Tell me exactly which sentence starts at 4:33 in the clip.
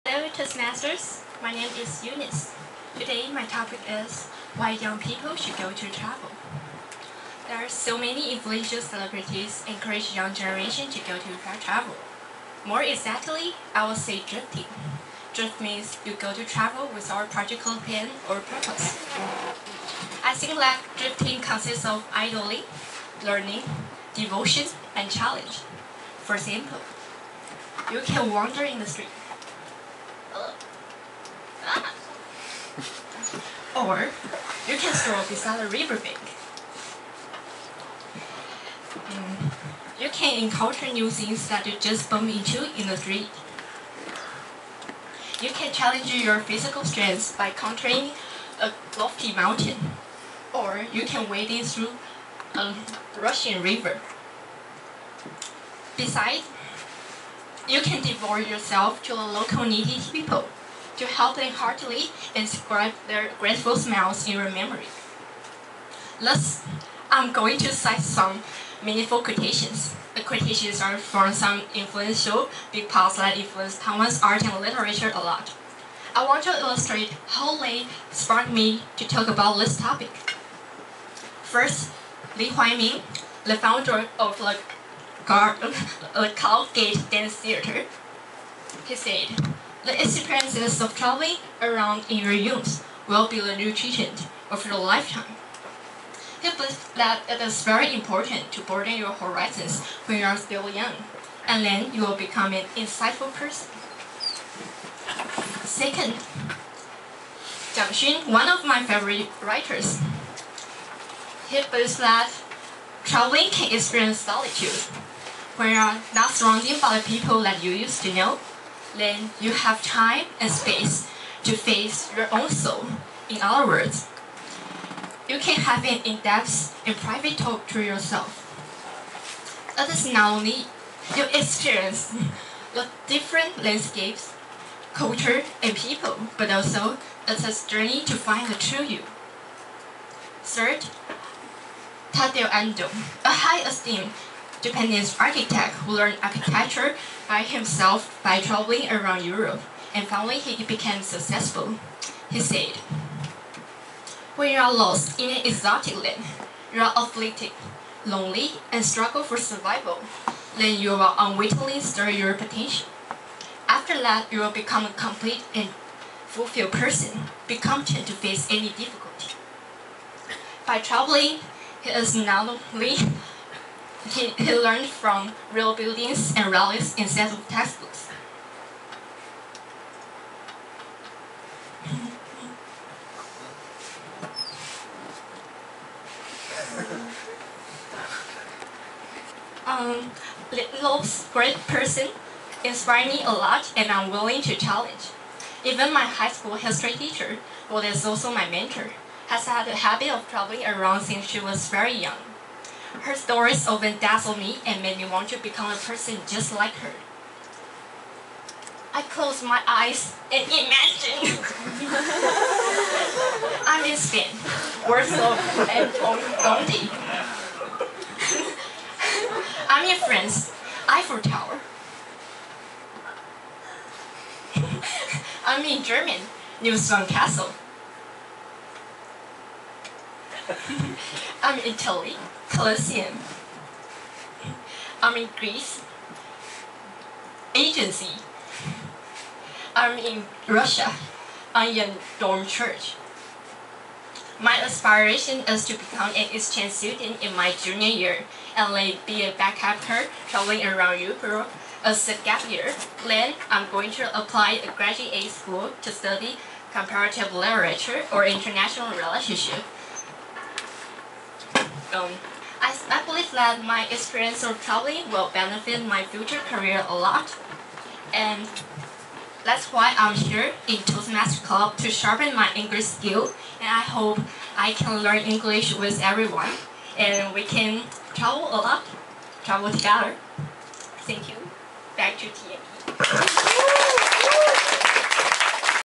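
And I hope I can learn English with everyone.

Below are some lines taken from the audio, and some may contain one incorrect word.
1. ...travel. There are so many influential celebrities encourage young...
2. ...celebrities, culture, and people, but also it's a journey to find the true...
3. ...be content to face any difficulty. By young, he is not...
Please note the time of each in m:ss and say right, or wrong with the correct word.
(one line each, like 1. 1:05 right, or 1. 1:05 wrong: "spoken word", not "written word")
1. 0:05 right
2. 2:13 wrong: "landscapes", not "celebrities"
3. 2:47 wrong: "traveling", not "young".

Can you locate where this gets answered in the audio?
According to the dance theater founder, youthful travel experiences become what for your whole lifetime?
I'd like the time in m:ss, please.
1:33.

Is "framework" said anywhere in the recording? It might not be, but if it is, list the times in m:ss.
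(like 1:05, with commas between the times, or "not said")
not said.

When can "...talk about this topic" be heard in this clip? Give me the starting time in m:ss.
1:19.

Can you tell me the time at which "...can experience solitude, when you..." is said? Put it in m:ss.
1:53.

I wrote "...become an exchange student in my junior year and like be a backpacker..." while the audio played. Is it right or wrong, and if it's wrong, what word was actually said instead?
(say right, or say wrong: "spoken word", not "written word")
right.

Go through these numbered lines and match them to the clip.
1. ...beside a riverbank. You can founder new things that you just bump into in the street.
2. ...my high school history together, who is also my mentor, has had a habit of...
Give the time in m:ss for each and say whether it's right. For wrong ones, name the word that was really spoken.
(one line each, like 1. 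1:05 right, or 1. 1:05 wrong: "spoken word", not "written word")
1. 0:35 wrong: "encounter", not "founder"
2. 3:15 wrong: "teacher", not "together".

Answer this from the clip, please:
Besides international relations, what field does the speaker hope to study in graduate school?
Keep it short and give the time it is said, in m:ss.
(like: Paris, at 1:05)
Comparative literature, at 4:16.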